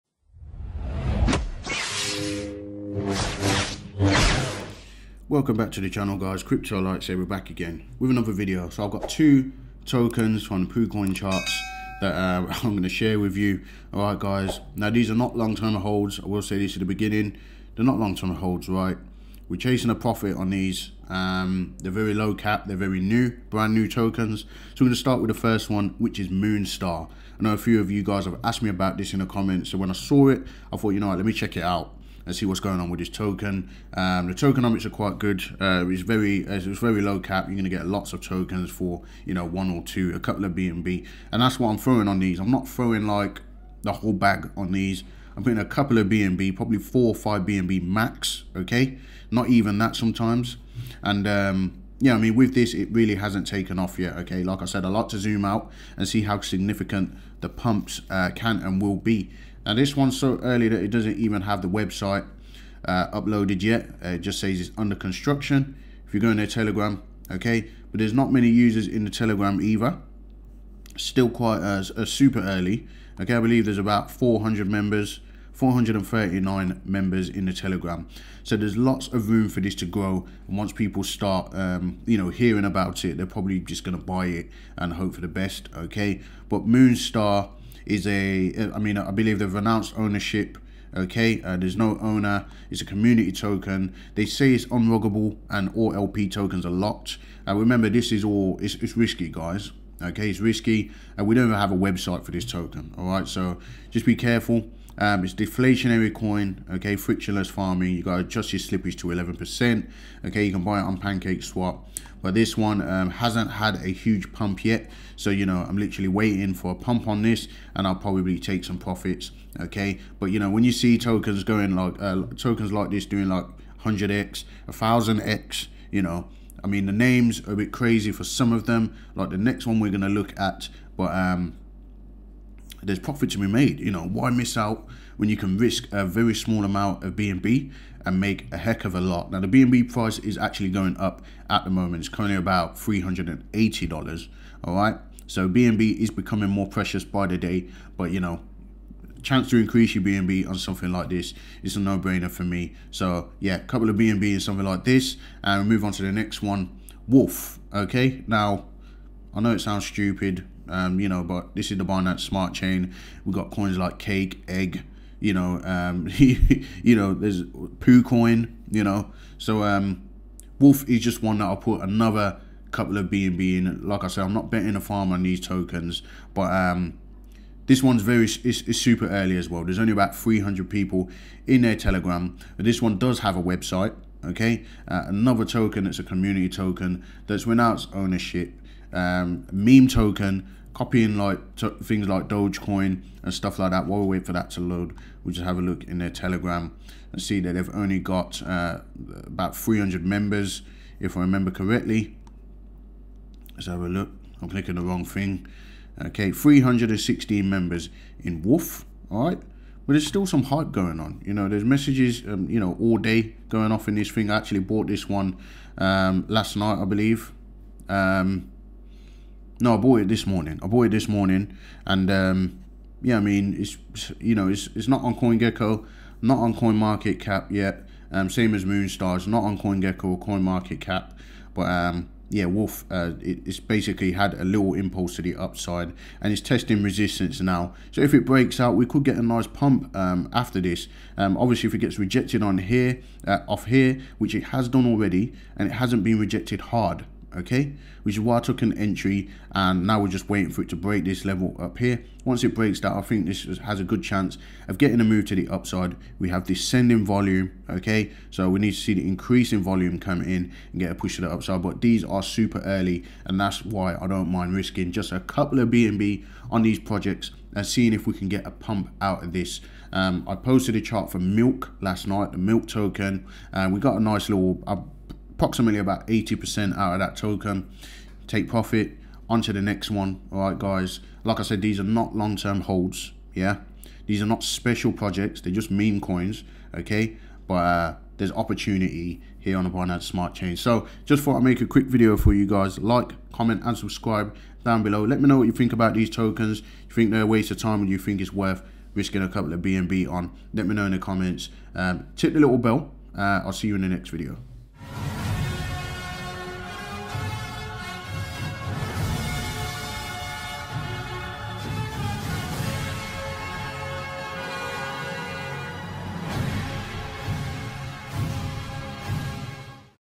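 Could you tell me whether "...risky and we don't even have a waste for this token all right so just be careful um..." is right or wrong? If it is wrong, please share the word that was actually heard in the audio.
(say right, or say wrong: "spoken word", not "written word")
wrong: "website", not "waste".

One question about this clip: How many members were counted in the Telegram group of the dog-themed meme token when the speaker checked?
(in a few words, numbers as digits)
316.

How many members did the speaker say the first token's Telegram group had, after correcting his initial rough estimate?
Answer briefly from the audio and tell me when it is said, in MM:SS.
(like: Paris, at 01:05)
439, at 01:15.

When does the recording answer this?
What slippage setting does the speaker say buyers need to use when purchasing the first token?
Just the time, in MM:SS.
01:49.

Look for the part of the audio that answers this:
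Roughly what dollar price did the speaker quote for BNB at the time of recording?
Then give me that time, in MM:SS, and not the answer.
02:22.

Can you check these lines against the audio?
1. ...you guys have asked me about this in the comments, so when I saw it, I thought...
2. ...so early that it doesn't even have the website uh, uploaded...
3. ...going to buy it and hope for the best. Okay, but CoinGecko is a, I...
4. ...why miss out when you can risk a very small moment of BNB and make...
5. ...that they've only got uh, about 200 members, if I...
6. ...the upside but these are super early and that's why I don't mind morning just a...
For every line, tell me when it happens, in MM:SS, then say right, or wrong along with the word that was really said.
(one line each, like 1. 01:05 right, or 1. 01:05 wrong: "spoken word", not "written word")
1. 00:27 right
2. 01:00 right
3. 01:23 wrong: "Moonstar", not "CoinGecko"
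4. 02:14 wrong: "amount", not "moment"
5. 03:17 wrong: "300", not "200"
6. 04:21 wrong: "risking", not "morning".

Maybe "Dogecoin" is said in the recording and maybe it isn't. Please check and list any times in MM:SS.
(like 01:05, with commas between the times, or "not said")
03:12.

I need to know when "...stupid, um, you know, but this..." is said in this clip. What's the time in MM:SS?
02:39.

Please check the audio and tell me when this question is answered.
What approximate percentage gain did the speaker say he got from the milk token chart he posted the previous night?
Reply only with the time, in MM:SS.
04:36.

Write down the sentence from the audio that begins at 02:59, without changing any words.
There's only about 300 people in their Telegram.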